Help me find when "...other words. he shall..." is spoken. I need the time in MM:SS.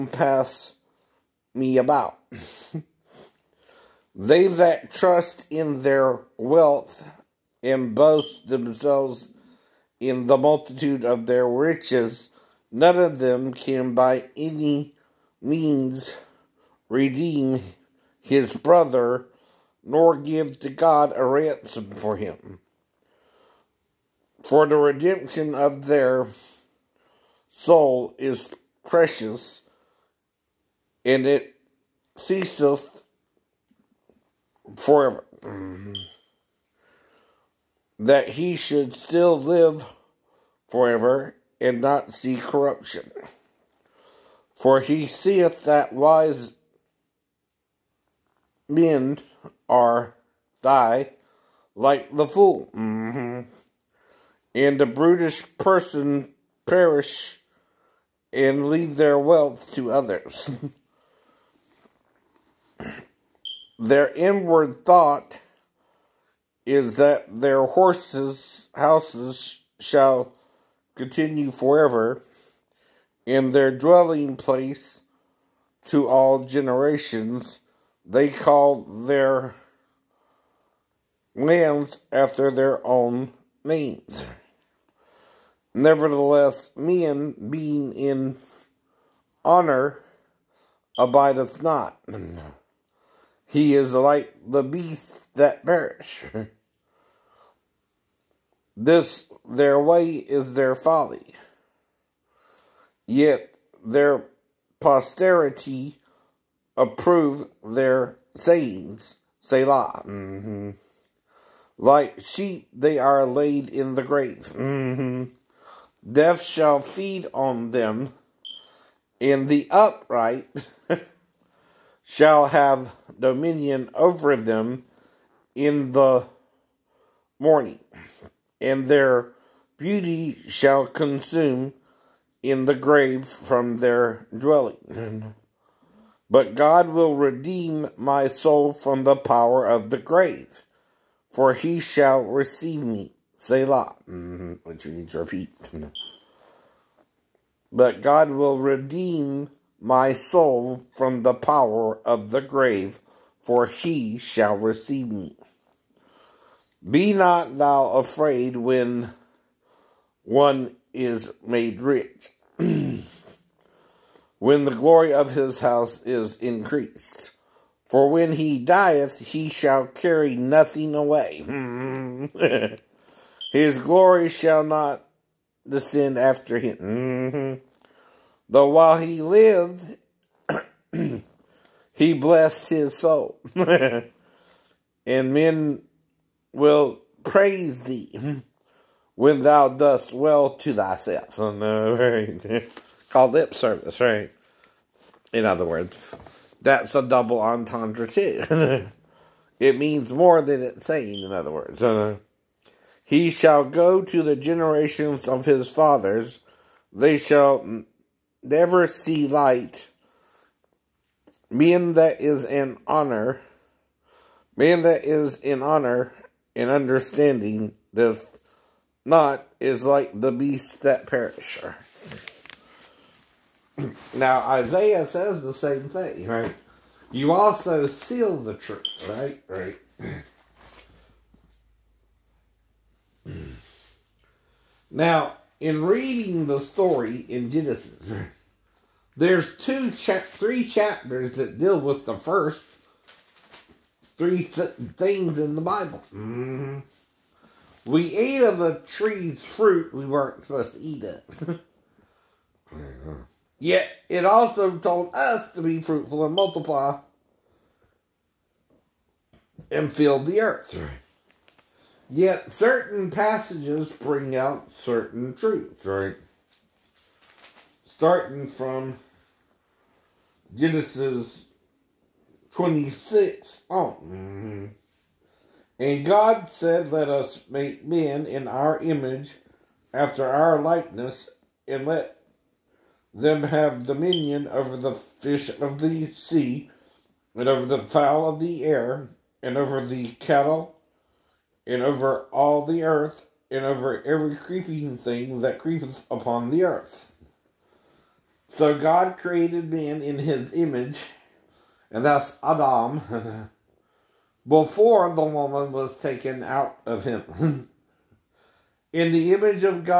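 03:21.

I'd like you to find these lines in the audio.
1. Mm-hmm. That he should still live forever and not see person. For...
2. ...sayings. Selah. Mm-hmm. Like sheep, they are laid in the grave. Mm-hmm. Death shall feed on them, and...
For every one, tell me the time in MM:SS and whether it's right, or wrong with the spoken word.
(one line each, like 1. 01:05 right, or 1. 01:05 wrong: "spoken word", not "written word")
1. 00:35 wrong: "corruption", not "person"
2. 01:48 right.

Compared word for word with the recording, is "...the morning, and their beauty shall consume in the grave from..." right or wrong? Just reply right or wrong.
right.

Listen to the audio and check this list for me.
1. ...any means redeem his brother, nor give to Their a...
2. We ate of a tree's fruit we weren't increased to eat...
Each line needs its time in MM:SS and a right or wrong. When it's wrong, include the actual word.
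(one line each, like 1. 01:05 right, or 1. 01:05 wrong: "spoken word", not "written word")
1. 00:14 wrong: "God", not "Their"
2. 04:07 wrong: "supposed", not "increased".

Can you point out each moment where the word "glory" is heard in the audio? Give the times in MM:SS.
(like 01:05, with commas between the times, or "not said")
02:44, 02:53.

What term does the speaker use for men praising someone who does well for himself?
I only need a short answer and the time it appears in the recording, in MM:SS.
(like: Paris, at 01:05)
lip service, at 03:13.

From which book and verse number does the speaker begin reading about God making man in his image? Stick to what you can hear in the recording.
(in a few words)
Genesis 26.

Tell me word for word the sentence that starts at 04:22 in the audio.
Yet certain passages bring out certain truths, right?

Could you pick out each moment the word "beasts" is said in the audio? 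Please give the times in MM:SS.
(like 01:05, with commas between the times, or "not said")
01:34, 03:40.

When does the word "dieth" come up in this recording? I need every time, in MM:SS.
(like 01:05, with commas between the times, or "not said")
02:48.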